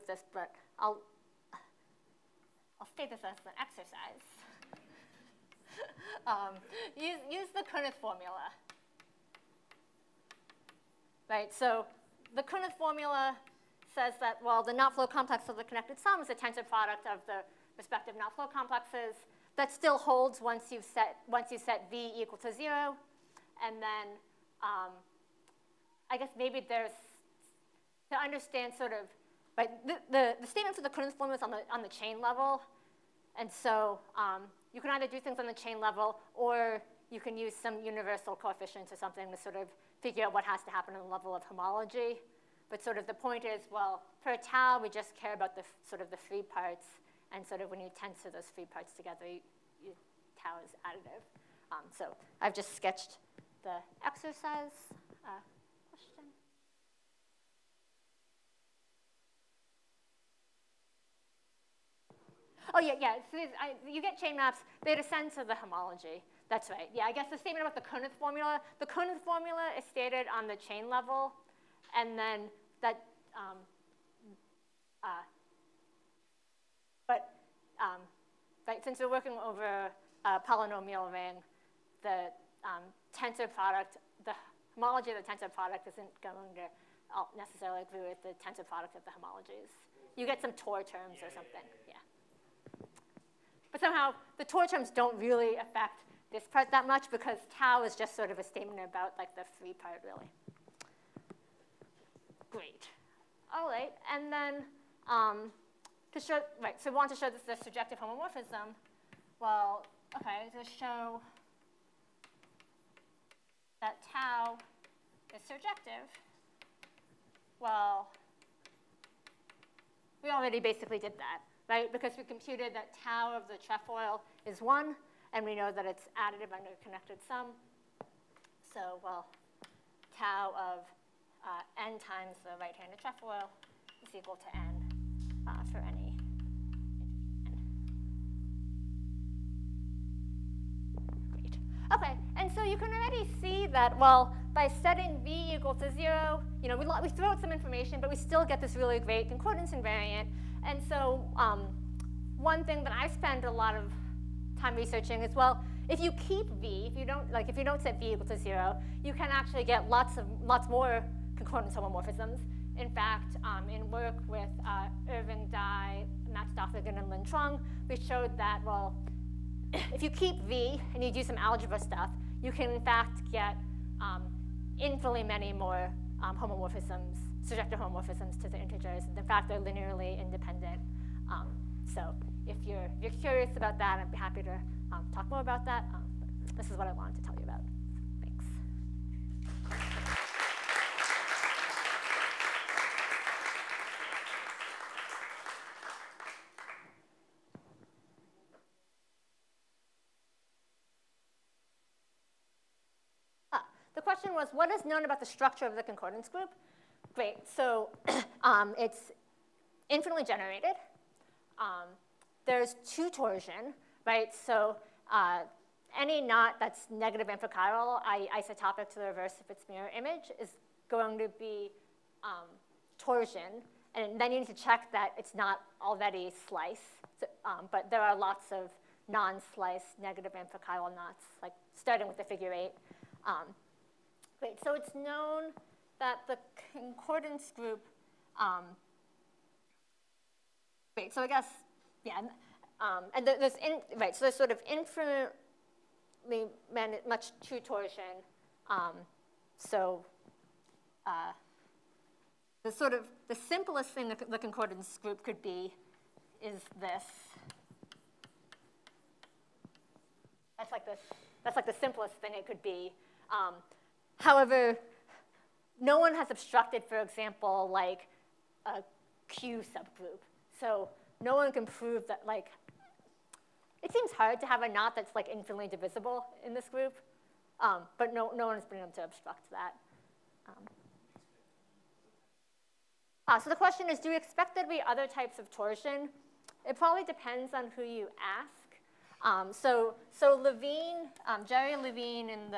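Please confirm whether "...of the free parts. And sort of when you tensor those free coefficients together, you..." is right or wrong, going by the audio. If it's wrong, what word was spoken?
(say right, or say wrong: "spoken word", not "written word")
wrong: "parts", not "coefficients".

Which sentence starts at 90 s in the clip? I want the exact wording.
You get some Tor terms yeah, or something.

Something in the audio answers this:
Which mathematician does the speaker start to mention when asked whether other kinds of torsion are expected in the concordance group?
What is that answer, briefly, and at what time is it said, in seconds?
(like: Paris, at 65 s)
Jerry Levine, at 291 s.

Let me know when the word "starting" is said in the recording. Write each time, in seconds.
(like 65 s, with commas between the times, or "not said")
231 s.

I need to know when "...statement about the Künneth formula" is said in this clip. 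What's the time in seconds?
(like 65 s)
67 s.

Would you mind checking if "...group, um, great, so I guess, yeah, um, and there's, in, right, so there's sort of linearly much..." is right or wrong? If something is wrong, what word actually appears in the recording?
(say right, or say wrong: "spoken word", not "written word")
wrong: "infinitely", not "linearly".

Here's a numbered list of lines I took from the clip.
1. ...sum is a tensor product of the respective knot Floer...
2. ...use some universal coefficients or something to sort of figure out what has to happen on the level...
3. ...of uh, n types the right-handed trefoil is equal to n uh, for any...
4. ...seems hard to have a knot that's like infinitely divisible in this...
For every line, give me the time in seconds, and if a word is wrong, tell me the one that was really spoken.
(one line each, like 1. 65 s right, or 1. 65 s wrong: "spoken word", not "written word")
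1. 15 s right
2. 37 s right
3. 130 s wrong: "times", not "types"
4. 273 s right.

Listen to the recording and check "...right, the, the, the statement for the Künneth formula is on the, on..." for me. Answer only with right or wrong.
right.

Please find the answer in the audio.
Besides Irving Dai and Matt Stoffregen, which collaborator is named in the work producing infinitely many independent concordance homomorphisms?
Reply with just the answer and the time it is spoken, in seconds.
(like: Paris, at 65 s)
Linh Truong, at 167 s.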